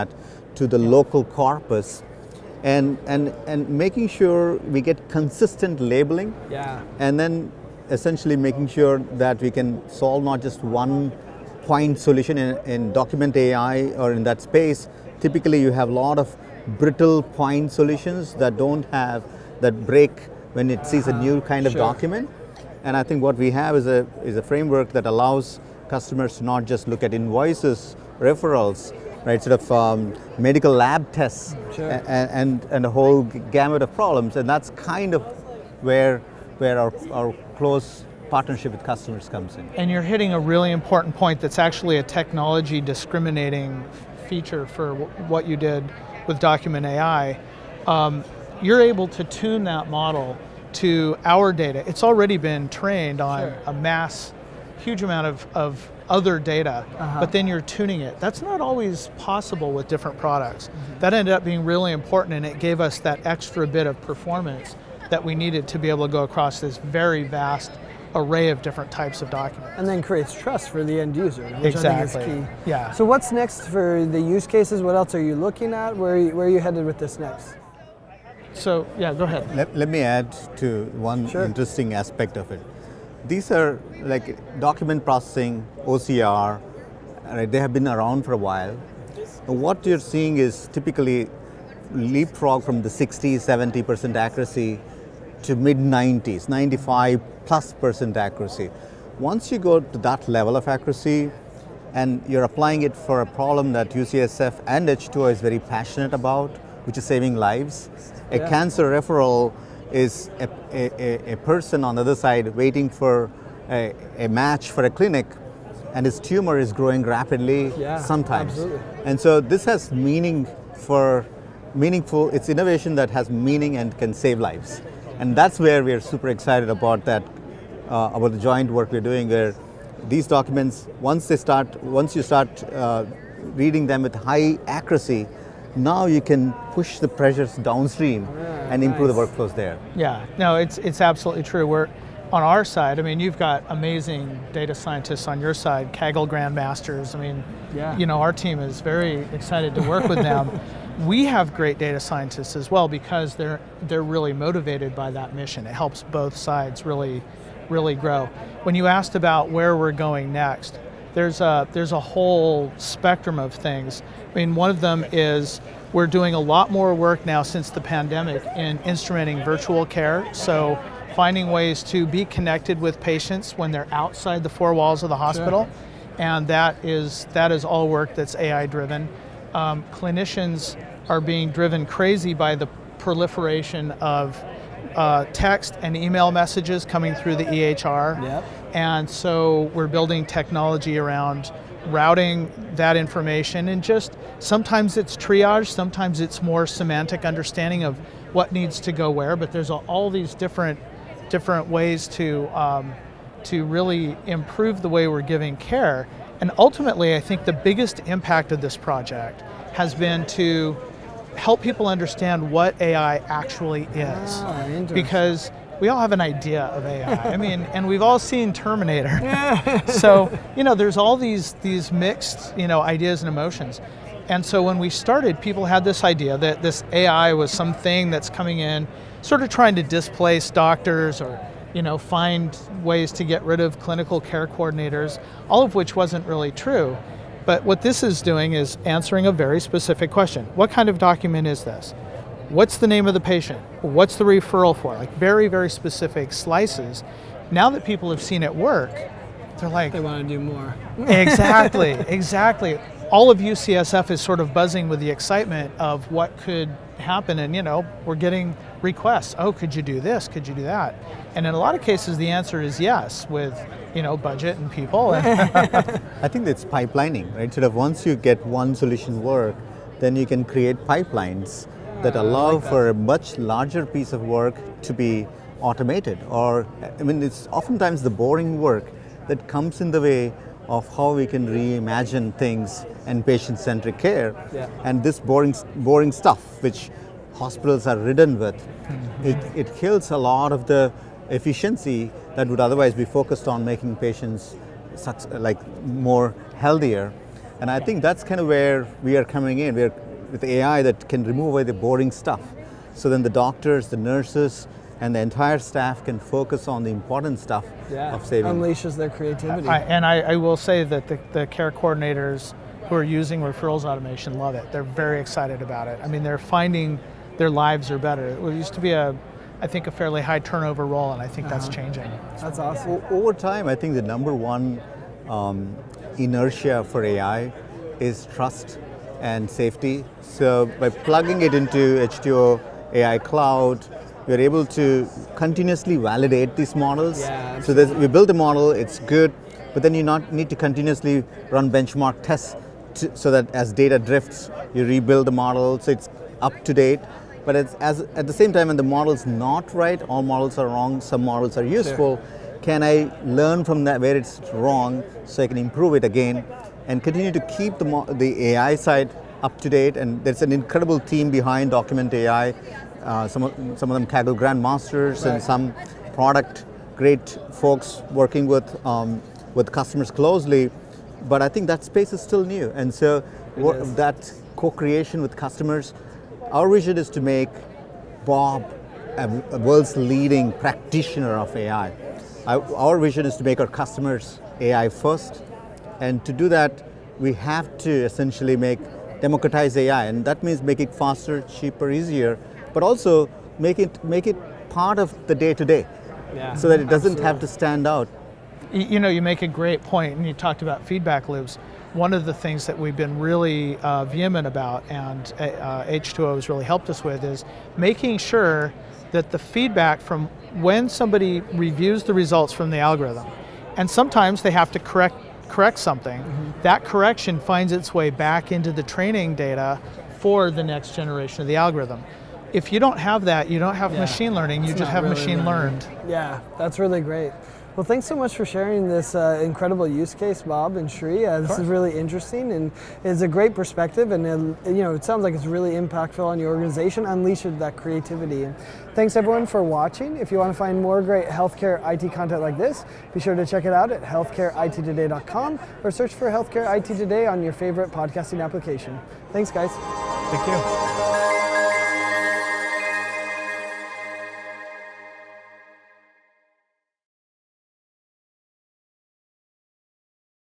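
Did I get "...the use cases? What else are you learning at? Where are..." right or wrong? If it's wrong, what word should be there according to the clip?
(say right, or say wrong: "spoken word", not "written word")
wrong: "looking", not "learning".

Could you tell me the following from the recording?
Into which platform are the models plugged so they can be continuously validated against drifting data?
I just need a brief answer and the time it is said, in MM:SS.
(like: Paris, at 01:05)
H2O AI Cloud, at 05:32.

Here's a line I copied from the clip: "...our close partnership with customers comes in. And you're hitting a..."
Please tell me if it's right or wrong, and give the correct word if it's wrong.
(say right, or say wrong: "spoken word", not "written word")
right.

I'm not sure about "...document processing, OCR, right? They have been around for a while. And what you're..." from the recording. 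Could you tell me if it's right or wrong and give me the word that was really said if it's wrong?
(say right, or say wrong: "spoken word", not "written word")
right.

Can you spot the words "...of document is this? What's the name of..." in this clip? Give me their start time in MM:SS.
04:00.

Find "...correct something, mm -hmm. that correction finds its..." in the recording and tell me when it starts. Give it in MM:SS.
06:55.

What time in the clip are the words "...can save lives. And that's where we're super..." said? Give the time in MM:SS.
02:03.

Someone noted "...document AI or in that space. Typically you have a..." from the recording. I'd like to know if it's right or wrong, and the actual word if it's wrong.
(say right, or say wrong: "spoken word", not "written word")
right.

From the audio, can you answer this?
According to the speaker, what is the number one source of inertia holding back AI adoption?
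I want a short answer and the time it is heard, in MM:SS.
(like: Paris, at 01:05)
Trust and safety, at 05:28.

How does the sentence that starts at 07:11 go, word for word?
Uh, this is really interesting and is a great perspective.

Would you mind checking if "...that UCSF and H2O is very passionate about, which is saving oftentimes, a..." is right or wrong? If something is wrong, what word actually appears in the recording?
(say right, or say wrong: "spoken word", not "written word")
wrong: "lives", not "oftentimes".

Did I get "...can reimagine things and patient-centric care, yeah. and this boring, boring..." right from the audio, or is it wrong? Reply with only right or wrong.
right.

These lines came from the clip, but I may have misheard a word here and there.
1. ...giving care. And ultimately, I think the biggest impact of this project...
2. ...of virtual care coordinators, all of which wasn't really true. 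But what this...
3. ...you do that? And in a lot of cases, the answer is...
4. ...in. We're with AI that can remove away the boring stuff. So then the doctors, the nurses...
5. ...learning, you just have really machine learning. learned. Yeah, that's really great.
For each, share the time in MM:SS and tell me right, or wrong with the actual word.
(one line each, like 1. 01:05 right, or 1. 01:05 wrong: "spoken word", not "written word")
1. 03:25 right
2. 03:53 wrong: "clinical", not "virtual"
3. 04:20 right
4. 04:59 right
5. 07:04 right.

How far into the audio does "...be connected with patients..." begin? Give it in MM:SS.
02:52.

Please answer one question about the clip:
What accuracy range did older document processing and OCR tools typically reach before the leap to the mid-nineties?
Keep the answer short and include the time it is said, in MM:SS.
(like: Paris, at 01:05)
60-70%, at 01:32.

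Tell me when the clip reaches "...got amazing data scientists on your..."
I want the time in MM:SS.
02:23.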